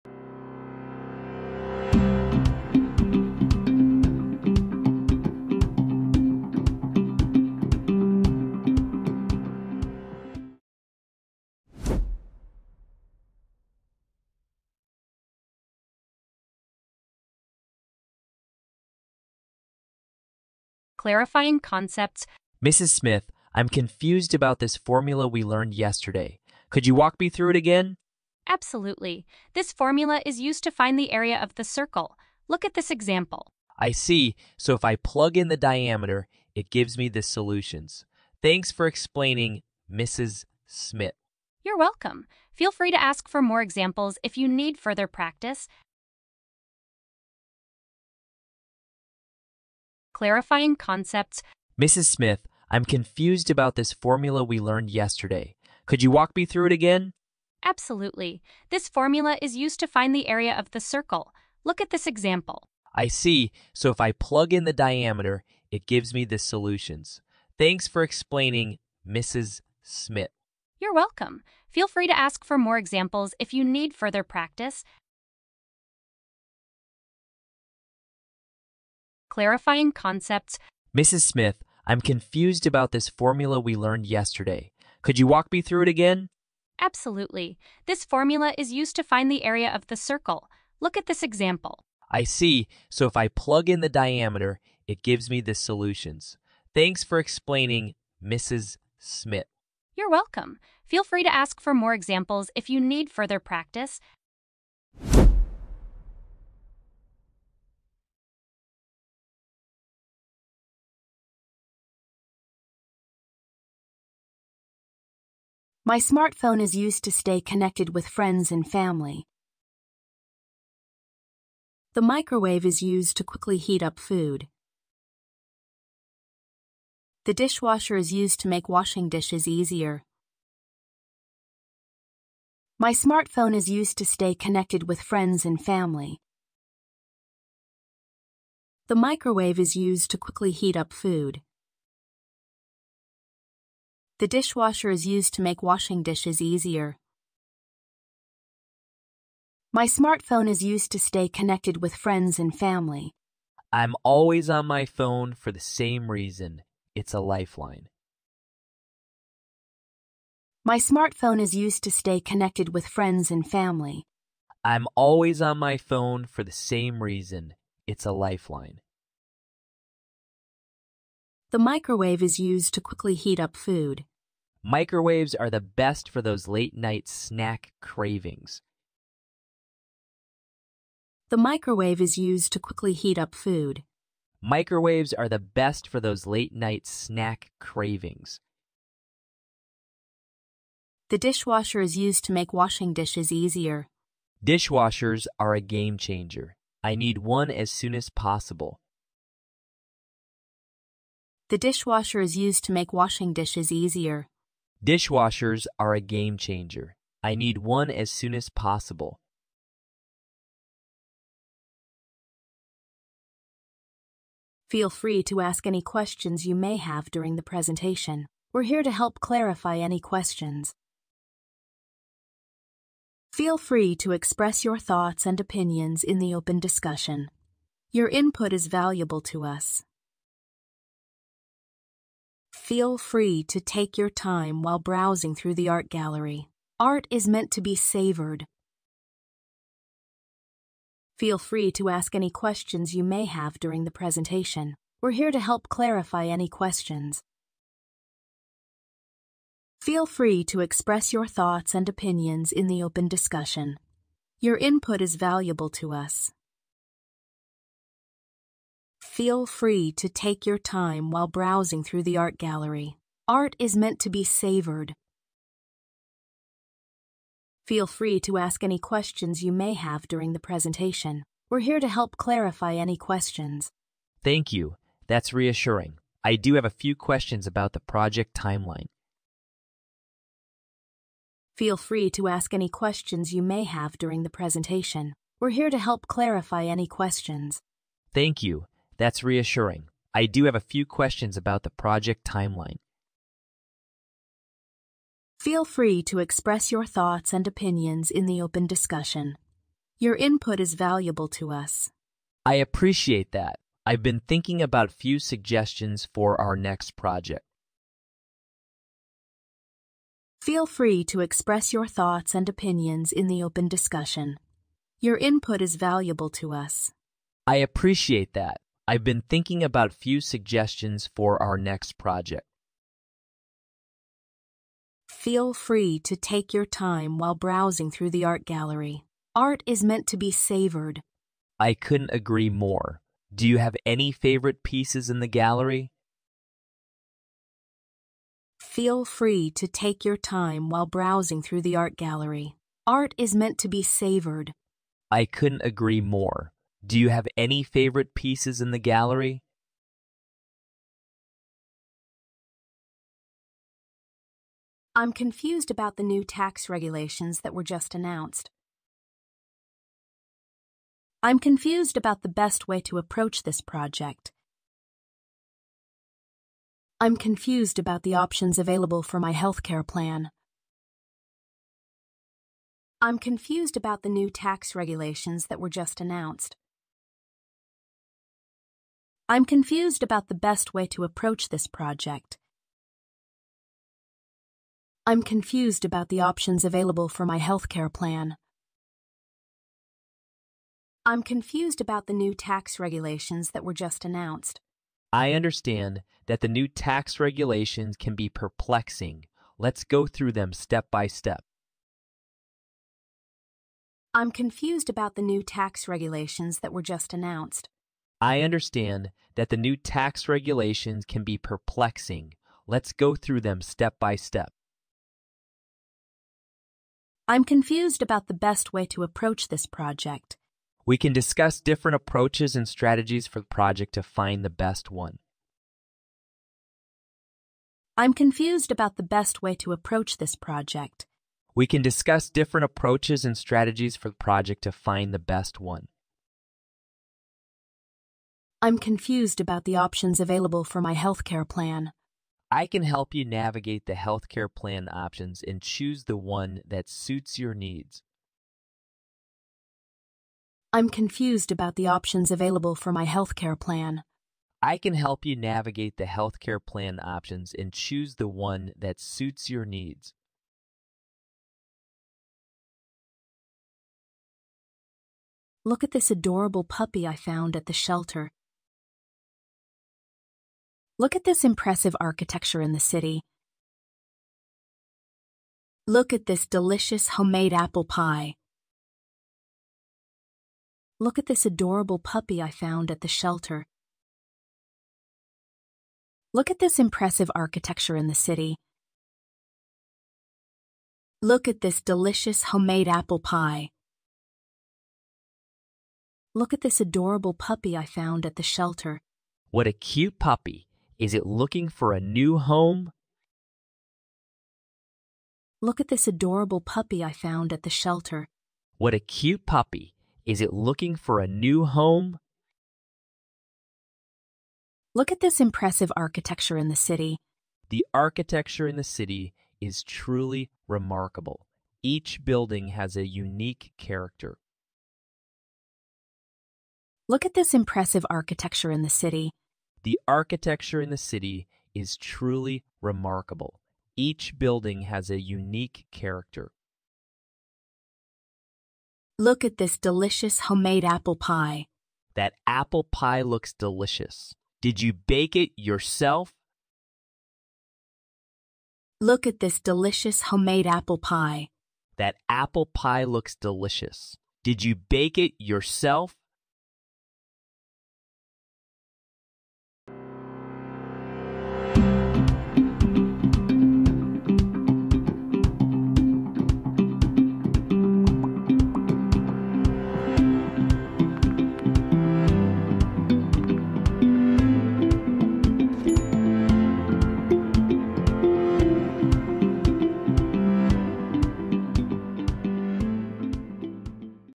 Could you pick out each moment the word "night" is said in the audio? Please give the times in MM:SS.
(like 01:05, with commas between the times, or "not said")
02:56, 03:06.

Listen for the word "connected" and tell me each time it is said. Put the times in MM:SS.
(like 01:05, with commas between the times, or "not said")
01:57, 02:14, 02:31, 02:42.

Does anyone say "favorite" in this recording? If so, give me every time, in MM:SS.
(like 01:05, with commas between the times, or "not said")
05:34, 05:47.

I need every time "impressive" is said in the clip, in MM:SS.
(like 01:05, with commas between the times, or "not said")
07:51, 08:06, 08:35, 08:47.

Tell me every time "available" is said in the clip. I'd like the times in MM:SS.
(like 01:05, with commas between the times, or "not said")
06:08, 06:26, 07:20, 07:32.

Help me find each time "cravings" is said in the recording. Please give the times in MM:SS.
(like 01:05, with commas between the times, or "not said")
02:57, 03:07.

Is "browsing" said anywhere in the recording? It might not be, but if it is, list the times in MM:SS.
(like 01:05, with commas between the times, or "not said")
03:54, 04:21, 05:27, 05:40.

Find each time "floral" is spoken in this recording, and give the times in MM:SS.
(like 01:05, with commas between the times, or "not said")
not said.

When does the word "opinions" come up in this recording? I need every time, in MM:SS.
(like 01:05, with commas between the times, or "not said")
03:45, 04:11, 04:57, 05:12.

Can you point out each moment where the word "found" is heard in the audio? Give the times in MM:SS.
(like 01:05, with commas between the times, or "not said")
07:47, 08:02, 08:17, 08:27.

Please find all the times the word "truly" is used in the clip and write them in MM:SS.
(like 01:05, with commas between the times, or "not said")
08:39, 08:51.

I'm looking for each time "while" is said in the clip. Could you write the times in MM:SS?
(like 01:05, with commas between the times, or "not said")
03:54, 04:21, 05:27, 05:40.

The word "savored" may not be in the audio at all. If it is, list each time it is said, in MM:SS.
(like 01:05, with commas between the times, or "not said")
03:57, 04:24, 05:30, 05:43.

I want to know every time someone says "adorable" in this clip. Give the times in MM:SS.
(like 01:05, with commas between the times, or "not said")
07:46, 08:01, 08:16, 08:26.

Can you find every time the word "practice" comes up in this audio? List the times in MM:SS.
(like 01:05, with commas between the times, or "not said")
00:45, 01:14, 01:43.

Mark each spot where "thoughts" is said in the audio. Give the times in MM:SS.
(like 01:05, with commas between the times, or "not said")
03:44, 04:11, 04:56, 05:11.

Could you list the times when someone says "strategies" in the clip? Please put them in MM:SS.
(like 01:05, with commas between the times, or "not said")
07:02, 07:13.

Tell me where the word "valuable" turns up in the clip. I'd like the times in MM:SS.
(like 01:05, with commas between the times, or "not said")
03:48, 04:15, 05:00, 05:15.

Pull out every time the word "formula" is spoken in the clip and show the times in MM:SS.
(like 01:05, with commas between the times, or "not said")
00:24, 00:29, 00:53, 00:58, 01:23, 01:28.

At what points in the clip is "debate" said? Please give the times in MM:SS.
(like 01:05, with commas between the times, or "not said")
not said.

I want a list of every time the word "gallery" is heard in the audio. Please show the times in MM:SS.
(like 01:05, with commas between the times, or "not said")
03:55, 04:22, 05:28, 05:35, 05:41, 05:48.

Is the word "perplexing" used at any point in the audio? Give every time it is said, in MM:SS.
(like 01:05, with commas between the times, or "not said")
06:38, 06:51.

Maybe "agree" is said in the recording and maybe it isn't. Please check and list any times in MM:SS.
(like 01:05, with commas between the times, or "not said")
05:32, 05:45.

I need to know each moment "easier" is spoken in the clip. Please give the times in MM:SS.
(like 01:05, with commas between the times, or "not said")
02:09, 02:26, 03:13, 03:23.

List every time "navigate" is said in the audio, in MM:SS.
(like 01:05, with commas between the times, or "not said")
07:23, 07:35.